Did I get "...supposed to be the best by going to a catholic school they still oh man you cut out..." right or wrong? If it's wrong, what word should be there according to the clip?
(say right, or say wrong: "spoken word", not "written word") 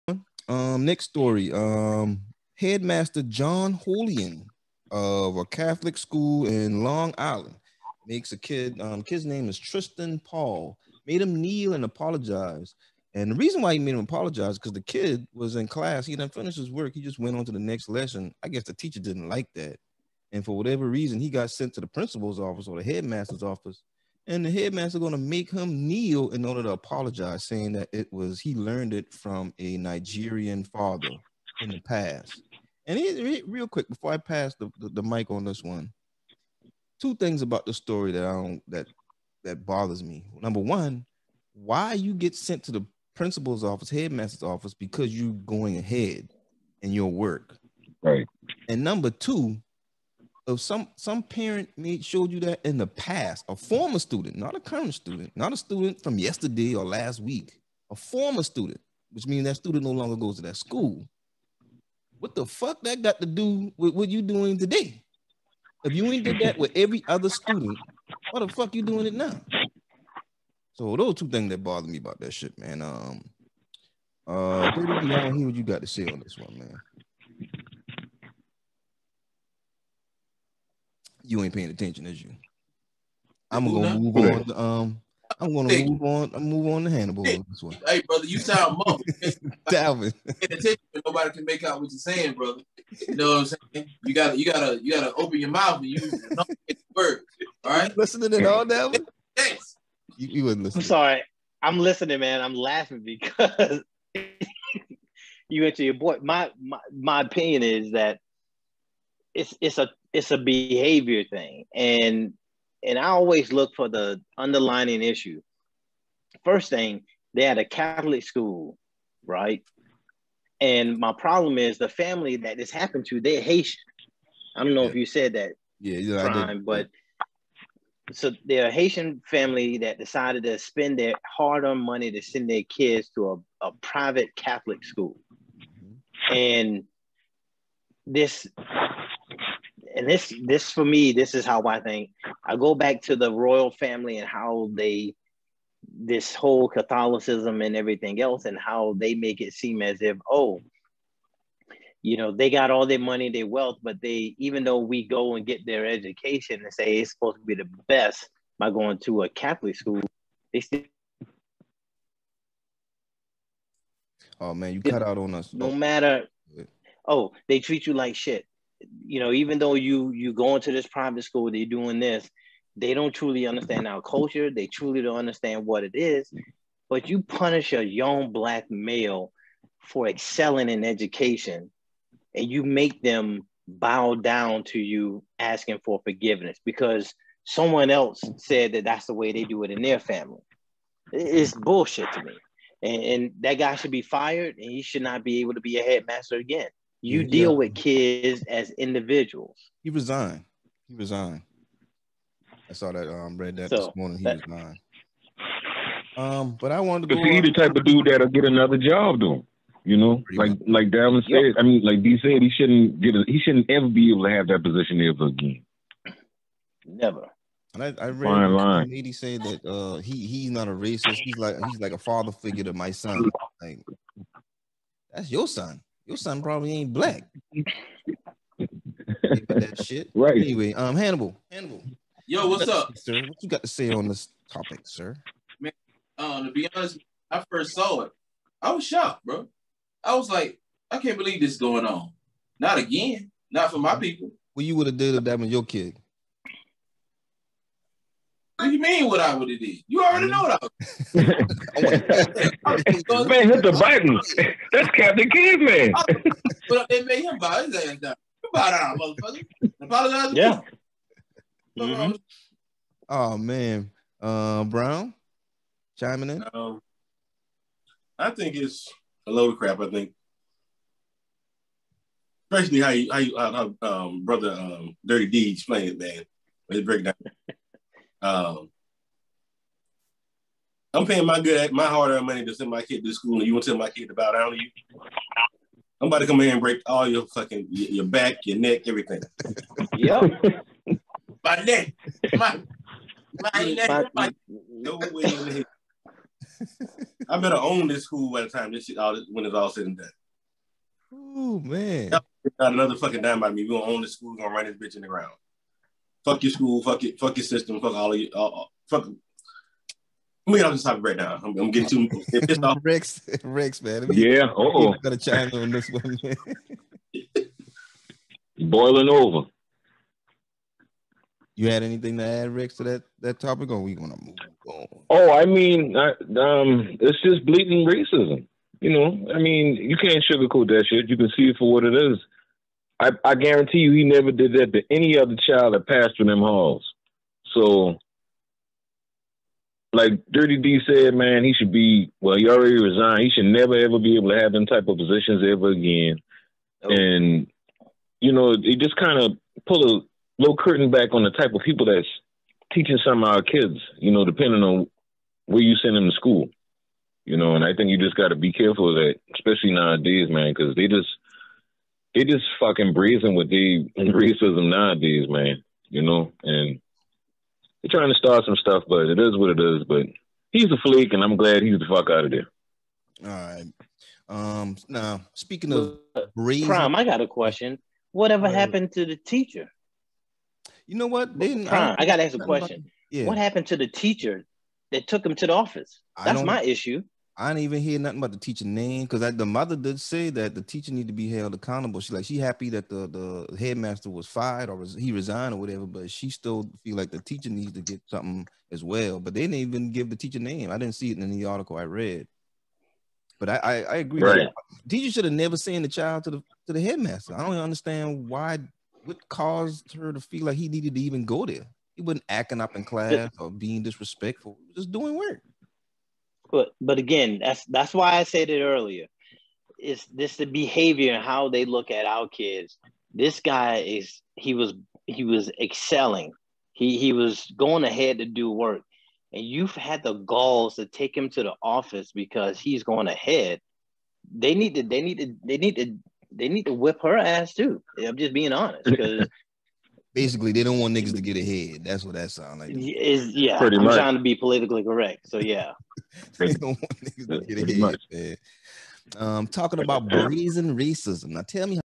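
right.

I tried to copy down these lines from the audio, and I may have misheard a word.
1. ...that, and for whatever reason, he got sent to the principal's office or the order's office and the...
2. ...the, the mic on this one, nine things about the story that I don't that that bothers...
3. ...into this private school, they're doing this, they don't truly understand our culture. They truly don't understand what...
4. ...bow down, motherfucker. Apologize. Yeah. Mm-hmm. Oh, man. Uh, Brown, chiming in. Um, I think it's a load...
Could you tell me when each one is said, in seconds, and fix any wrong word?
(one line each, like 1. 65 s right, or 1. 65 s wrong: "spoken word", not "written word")
1. 19 s wrong: "headmaster", not "order"
2. 34 s wrong: "two", not "nine"
3. 170 s right
4. 258 s right.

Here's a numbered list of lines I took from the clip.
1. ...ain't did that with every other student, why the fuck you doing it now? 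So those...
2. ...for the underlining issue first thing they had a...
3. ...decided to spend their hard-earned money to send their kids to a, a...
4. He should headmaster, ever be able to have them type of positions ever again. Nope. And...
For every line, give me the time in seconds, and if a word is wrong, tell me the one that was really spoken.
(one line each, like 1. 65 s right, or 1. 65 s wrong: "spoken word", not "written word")
1. 66 s right
2. 113 s right
3. 129 s right
4. 343 s wrong: "never", not "headmaster".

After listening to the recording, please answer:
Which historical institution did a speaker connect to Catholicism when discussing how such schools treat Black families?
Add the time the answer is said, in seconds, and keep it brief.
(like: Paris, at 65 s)
The royal family, at 143 s.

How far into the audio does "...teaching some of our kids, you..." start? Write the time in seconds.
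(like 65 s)
352 s.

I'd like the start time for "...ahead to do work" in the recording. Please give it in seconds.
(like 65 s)
427 s.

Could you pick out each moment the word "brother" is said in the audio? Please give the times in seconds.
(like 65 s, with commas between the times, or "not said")
88 s, 92 s, 274 s.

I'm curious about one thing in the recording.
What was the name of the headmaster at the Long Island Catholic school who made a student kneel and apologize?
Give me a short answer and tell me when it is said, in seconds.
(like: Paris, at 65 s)
John Holian, at 3 s.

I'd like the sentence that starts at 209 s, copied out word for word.
You know, like like Dalvin said.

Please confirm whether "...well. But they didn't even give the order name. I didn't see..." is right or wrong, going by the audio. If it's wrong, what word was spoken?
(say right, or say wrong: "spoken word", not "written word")
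wrong: "teacher", not "order".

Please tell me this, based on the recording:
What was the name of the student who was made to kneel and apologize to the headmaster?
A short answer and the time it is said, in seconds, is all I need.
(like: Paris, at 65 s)
Tristan Paul, at 9 s.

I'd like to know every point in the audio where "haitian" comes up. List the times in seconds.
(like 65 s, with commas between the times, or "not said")
123 s, 128 s.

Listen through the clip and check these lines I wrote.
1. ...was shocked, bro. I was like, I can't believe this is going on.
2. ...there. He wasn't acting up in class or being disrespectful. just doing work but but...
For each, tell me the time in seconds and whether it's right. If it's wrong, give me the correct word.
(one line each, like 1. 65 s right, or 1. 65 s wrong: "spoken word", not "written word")
1. 238 s right
2. 411 s right.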